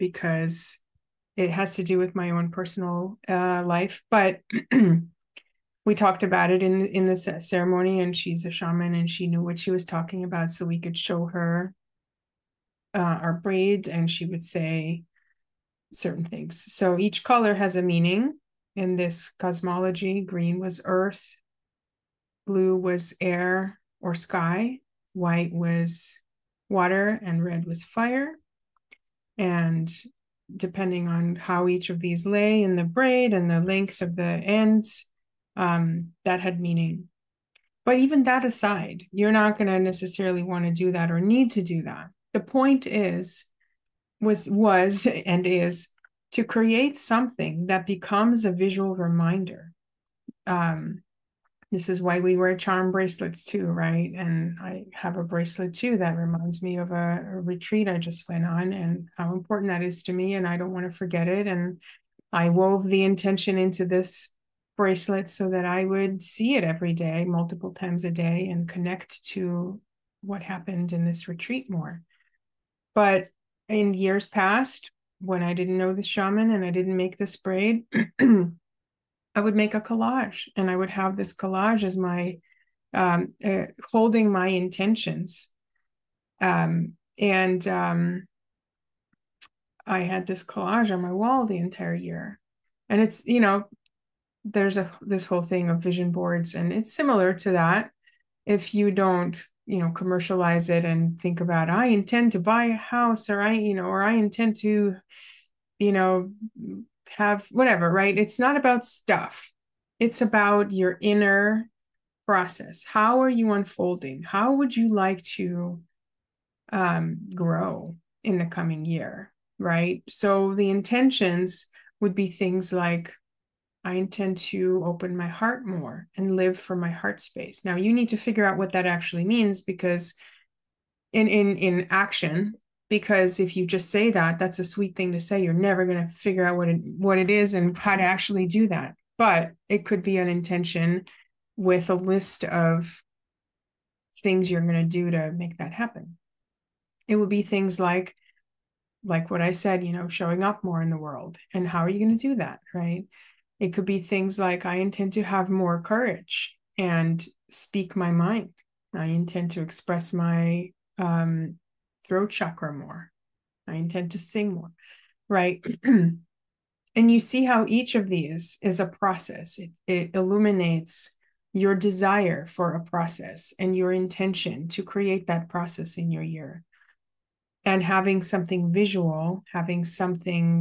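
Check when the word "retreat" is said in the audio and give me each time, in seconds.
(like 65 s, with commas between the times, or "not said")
57 s, 71 s.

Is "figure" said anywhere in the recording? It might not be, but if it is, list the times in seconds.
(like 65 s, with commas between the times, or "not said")
128 s, 136 s.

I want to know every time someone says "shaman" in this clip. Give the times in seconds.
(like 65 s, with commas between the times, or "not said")
8 s, 76 s.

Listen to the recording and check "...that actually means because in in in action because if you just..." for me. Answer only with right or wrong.
right.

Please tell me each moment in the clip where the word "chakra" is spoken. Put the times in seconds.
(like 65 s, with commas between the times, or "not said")
162 s.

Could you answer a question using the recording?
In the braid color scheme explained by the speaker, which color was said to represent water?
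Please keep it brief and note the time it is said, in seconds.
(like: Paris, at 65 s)
White, at 25 s.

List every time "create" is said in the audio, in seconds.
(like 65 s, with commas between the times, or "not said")
46 s, 174 s.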